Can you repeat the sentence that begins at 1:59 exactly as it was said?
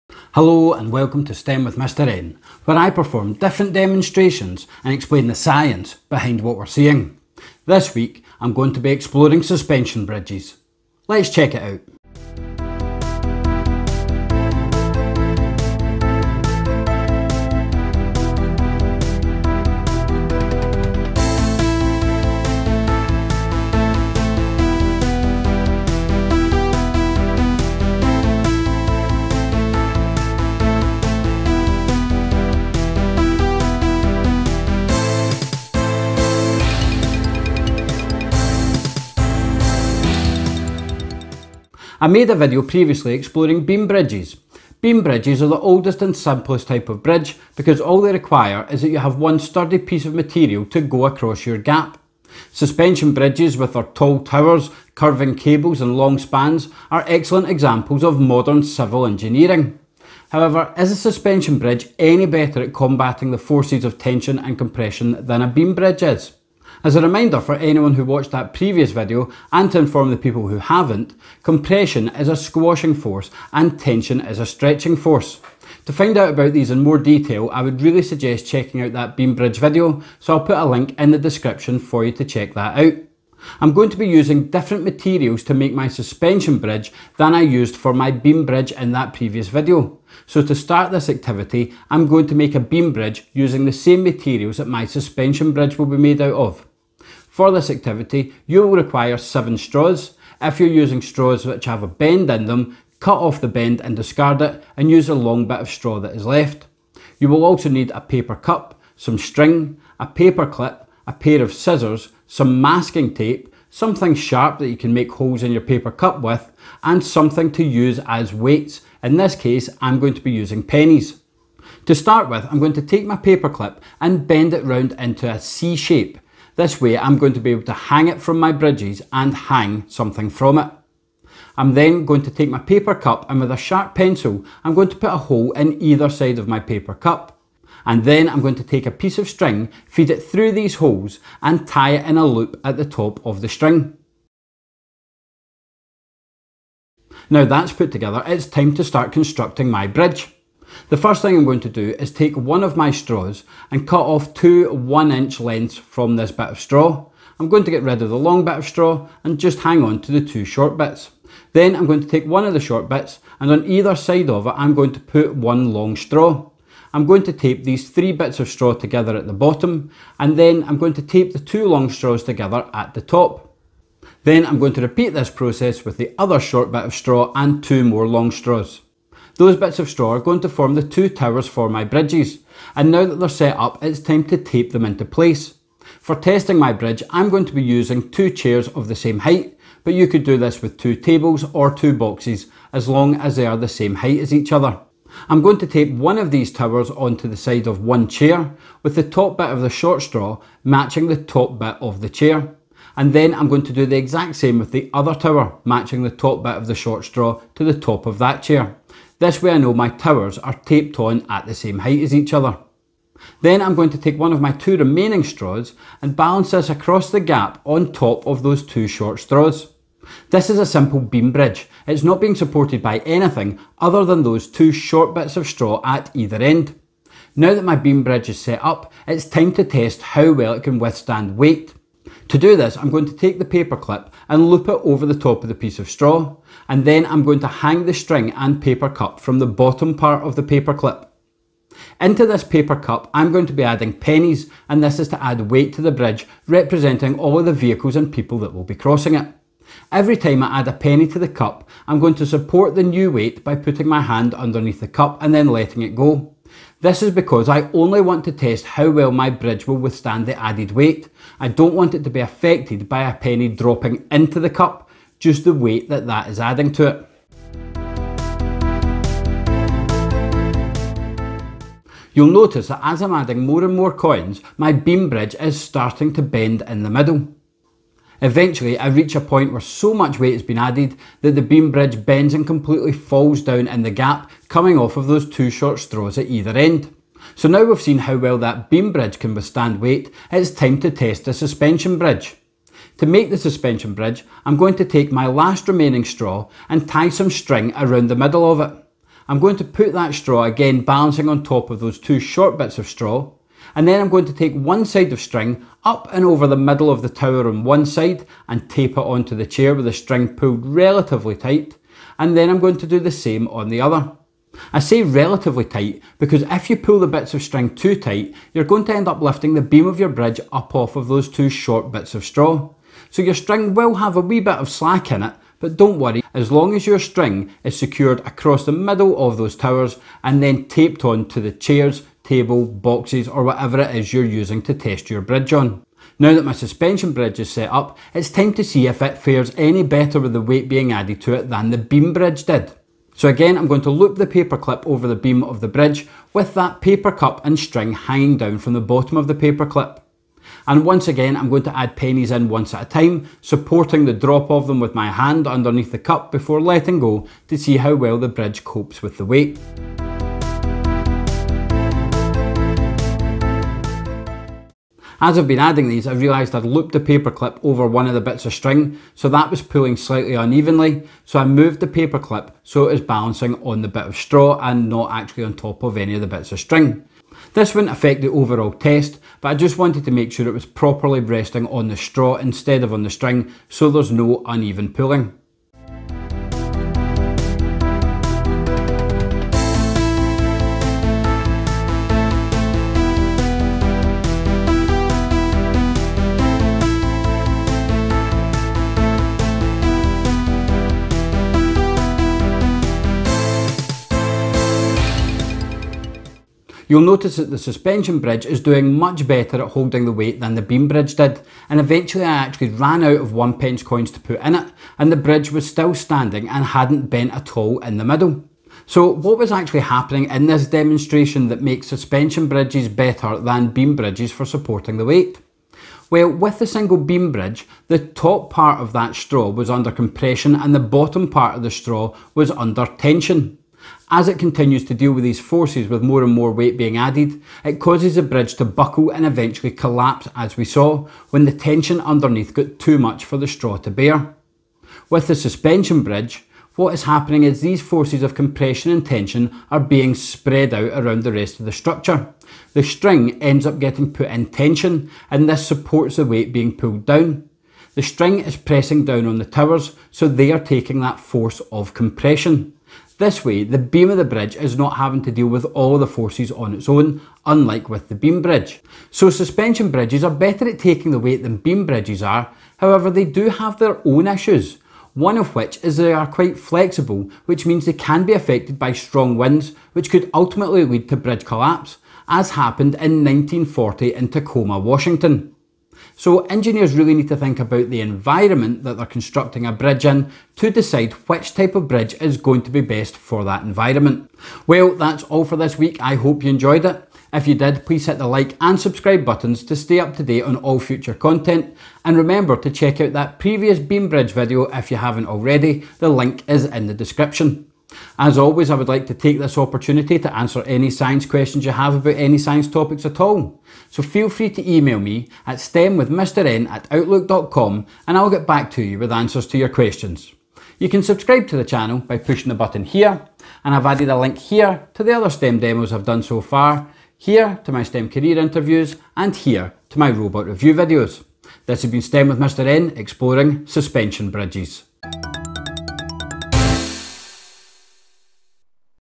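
In this case, I'm going to be using pennies.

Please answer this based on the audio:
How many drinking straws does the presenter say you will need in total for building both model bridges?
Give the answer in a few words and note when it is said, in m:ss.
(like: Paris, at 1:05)
7, at 1:39.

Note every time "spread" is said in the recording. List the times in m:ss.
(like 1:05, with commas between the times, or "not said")
7:30.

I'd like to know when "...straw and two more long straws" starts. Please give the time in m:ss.
2:56.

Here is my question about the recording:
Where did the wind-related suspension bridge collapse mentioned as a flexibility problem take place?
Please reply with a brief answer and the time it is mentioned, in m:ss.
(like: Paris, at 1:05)
Tacoma, Washington, at 8:04.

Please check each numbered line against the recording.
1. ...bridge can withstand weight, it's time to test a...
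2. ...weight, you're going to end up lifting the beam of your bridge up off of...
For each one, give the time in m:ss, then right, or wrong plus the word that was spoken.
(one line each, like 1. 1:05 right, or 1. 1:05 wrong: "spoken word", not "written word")
1. 4:48 right
2. 5:17 wrong: "tight", not "weight".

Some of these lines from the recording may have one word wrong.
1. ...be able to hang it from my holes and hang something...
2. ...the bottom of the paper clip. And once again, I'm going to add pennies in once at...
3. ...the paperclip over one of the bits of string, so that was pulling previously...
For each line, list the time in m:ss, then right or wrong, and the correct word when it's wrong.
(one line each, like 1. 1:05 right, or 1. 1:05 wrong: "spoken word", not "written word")
1. 2:07 wrong: "bridges", not "holes"
2. 5:48 right
3. 6:06 wrong: "slightly", not "previously".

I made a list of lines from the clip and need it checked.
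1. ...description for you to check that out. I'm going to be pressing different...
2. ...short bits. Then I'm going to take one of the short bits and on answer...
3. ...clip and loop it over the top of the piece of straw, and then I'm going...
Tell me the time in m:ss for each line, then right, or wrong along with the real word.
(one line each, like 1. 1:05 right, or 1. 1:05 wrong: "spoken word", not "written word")
1. 1:21 wrong: "using", not "pressing"
2. 2:40 wrong: "either", not "answer"
3. 3:53 right.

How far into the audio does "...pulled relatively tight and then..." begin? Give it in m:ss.
5:10.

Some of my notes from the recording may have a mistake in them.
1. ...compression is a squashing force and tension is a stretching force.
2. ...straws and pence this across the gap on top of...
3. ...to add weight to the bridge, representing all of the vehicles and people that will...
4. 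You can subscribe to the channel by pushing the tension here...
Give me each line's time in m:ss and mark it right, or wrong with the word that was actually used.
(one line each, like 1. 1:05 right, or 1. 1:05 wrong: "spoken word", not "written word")
1. 1:11 right
2. 3:35 wrong: "balance", not "pence"
3. 4:05 right
4. 8:40 wrong: "button", not "tension".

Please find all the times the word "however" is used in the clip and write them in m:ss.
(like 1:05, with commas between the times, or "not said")
1:00, 7:52.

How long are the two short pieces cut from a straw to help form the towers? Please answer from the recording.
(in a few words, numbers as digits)
one inch.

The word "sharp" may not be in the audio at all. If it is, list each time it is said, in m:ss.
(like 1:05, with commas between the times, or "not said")
1:54, 2:13.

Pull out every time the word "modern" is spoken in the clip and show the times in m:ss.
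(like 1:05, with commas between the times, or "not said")
0:58.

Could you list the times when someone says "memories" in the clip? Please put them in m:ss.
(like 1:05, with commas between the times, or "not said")
not said.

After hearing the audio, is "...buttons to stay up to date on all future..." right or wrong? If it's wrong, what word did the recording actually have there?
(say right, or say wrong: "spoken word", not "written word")
right.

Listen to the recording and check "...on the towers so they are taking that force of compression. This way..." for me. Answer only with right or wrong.
right.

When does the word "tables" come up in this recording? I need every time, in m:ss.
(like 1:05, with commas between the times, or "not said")
3:10, 5:32.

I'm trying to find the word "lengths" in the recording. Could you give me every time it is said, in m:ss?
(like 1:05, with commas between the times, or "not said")
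2:35.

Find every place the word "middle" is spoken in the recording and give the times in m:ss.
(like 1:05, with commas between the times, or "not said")
4:36, 4:58, 5:06, 5:28, 6:58.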